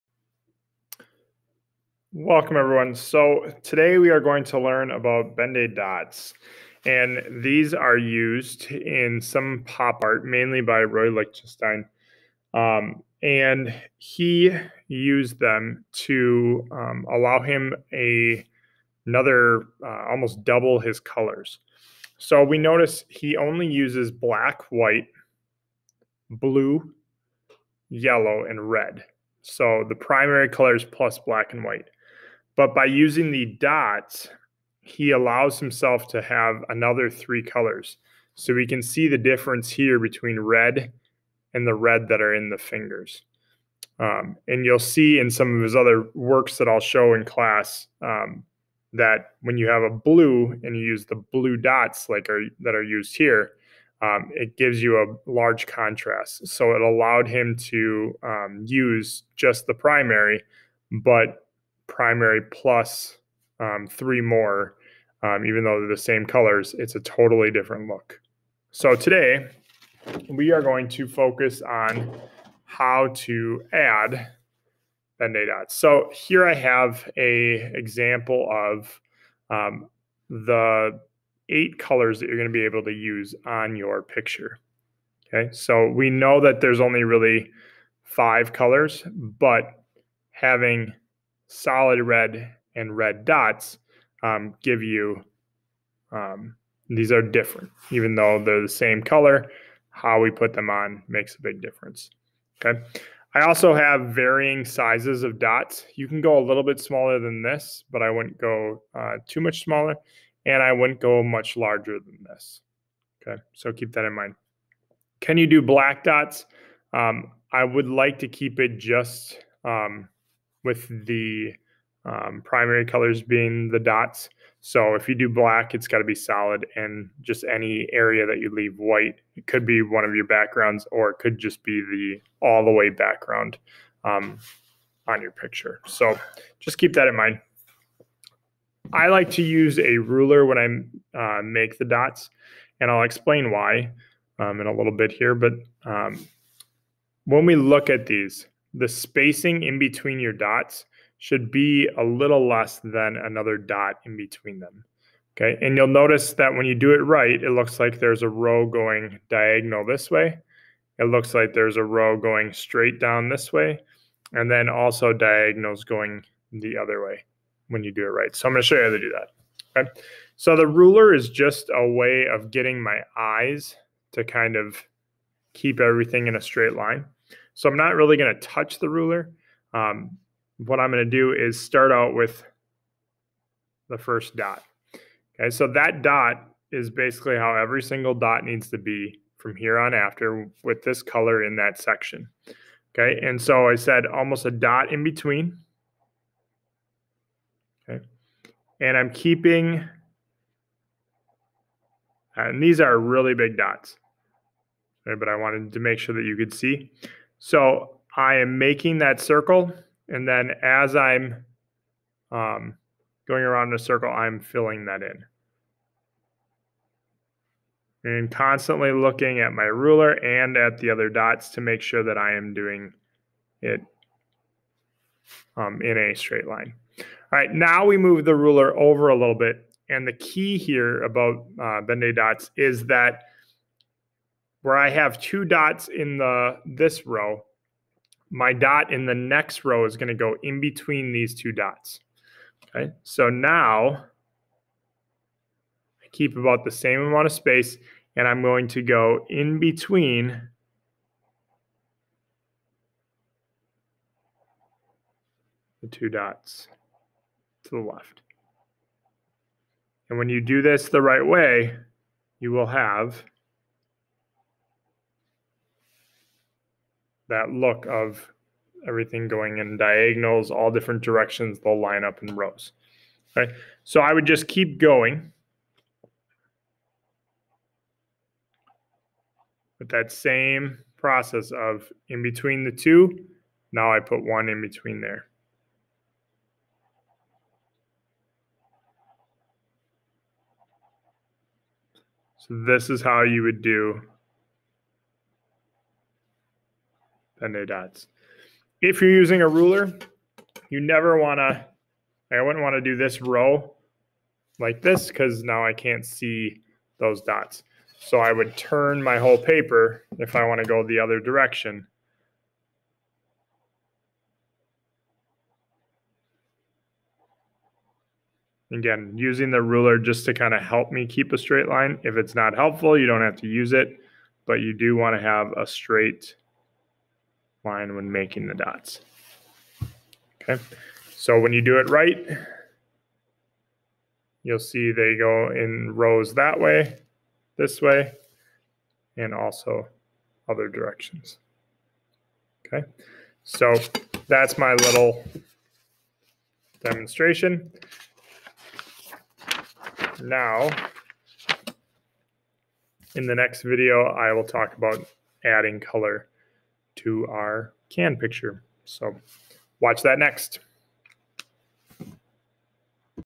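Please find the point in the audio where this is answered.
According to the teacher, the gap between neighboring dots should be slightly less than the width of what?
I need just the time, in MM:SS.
02:33.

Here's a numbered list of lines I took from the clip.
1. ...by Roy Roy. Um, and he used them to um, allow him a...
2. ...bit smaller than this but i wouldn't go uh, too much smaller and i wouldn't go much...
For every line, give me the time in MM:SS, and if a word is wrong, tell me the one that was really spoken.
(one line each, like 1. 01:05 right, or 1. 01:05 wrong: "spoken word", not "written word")
1. 00:10 wrong: "Lichtenstein", not "Roy"
2. 01:46 right.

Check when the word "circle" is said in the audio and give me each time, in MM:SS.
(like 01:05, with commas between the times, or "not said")
03:29, 03:33.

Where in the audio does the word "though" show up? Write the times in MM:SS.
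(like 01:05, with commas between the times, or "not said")
01:05, 01:38.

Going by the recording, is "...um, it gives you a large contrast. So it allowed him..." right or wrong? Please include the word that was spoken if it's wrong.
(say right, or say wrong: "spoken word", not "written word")
right.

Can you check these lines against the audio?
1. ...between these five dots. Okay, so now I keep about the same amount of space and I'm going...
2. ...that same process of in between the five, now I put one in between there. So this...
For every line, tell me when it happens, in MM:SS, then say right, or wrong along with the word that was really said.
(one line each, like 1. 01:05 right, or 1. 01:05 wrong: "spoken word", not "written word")
1. 04:00 wrong: "two", not "five"
2. 04:39 wrong: "two", not "five".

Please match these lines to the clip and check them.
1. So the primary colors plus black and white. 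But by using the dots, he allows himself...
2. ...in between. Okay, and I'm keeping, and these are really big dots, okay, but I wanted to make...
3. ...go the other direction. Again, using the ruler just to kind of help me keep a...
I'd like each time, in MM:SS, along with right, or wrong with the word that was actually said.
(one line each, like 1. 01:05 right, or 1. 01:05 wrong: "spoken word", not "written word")
1. 00:29 right
2. 03:14 right
3. 05:10 right.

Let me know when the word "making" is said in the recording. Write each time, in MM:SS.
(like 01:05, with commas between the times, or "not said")
03:28, 05:28.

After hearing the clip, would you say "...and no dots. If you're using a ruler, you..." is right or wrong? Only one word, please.
right.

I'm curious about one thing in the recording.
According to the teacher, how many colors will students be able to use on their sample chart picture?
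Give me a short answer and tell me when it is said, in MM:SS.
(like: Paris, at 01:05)
8, at 01:21.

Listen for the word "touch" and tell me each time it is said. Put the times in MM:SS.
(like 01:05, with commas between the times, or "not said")
02:58.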